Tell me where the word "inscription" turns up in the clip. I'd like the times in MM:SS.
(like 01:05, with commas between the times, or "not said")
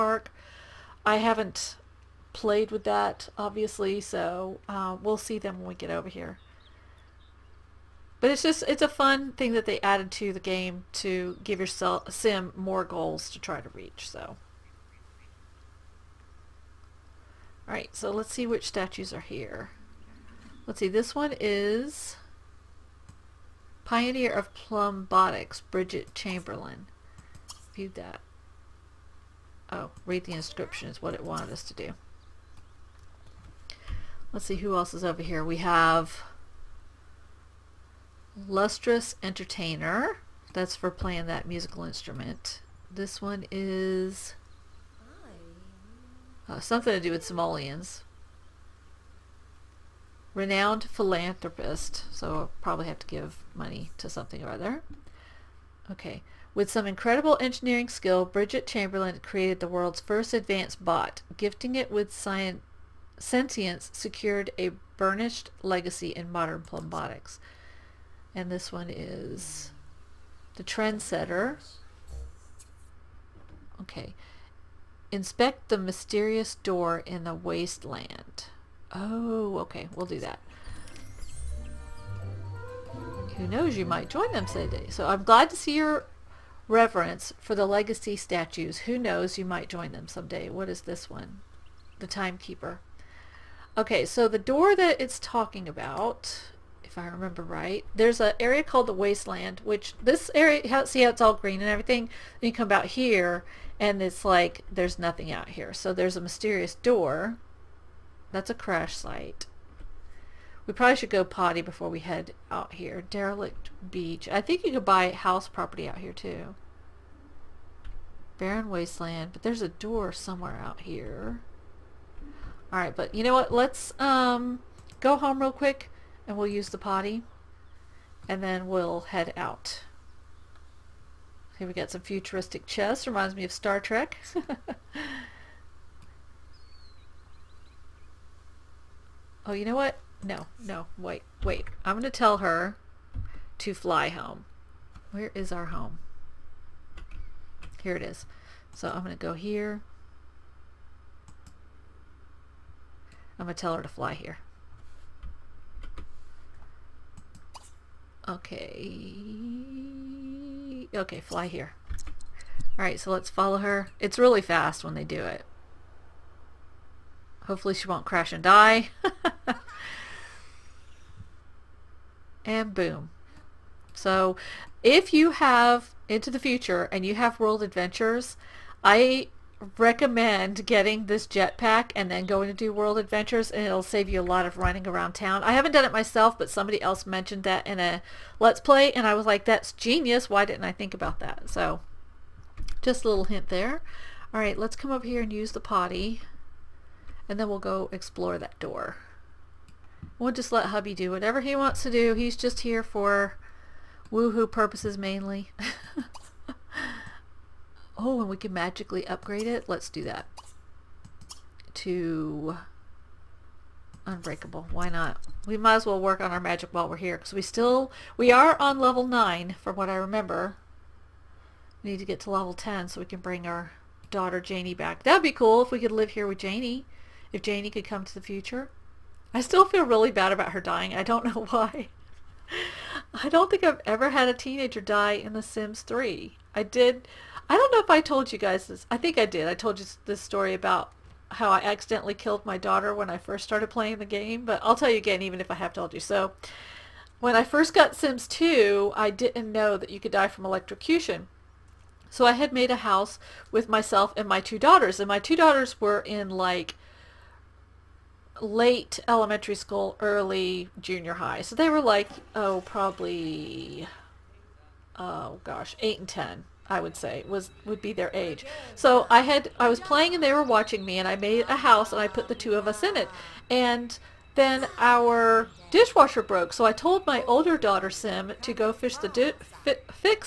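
00:30.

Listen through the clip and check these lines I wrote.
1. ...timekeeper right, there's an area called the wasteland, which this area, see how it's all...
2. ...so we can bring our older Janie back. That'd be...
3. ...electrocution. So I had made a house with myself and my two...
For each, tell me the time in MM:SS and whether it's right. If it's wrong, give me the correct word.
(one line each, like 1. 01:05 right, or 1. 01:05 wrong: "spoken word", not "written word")
1. 01:37 wrong: "remember", not "timekeeper"
2. 03:42 wrong: "daughter", not "older"
3. 04:10 right.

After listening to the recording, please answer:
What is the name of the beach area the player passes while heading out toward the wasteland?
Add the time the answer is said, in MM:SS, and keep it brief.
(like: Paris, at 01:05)
Derelict Beach, at 01:53.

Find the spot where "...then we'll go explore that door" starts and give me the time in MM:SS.
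03:17.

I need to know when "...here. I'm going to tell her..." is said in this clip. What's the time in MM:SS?
02:29.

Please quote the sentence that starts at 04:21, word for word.
So they were like, oh, probably, oh gosh, 8 and 10, I would say, was would be their age.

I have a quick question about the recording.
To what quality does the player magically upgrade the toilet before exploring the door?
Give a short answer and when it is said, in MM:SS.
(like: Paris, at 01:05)
Unbreakable, at 03:34.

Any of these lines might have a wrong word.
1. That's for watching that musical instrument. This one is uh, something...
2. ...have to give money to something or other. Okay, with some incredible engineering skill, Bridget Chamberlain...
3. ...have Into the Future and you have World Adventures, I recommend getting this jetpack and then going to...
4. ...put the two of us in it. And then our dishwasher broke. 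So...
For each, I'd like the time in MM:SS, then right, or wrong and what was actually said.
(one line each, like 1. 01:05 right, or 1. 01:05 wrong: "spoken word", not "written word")
1. 00:40 wrong: "playing", not "watching"
2. 00:52 right
3. 02:55 right
4. 04:32 right.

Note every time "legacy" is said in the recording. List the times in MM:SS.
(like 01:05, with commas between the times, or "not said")
01:05, 01:27.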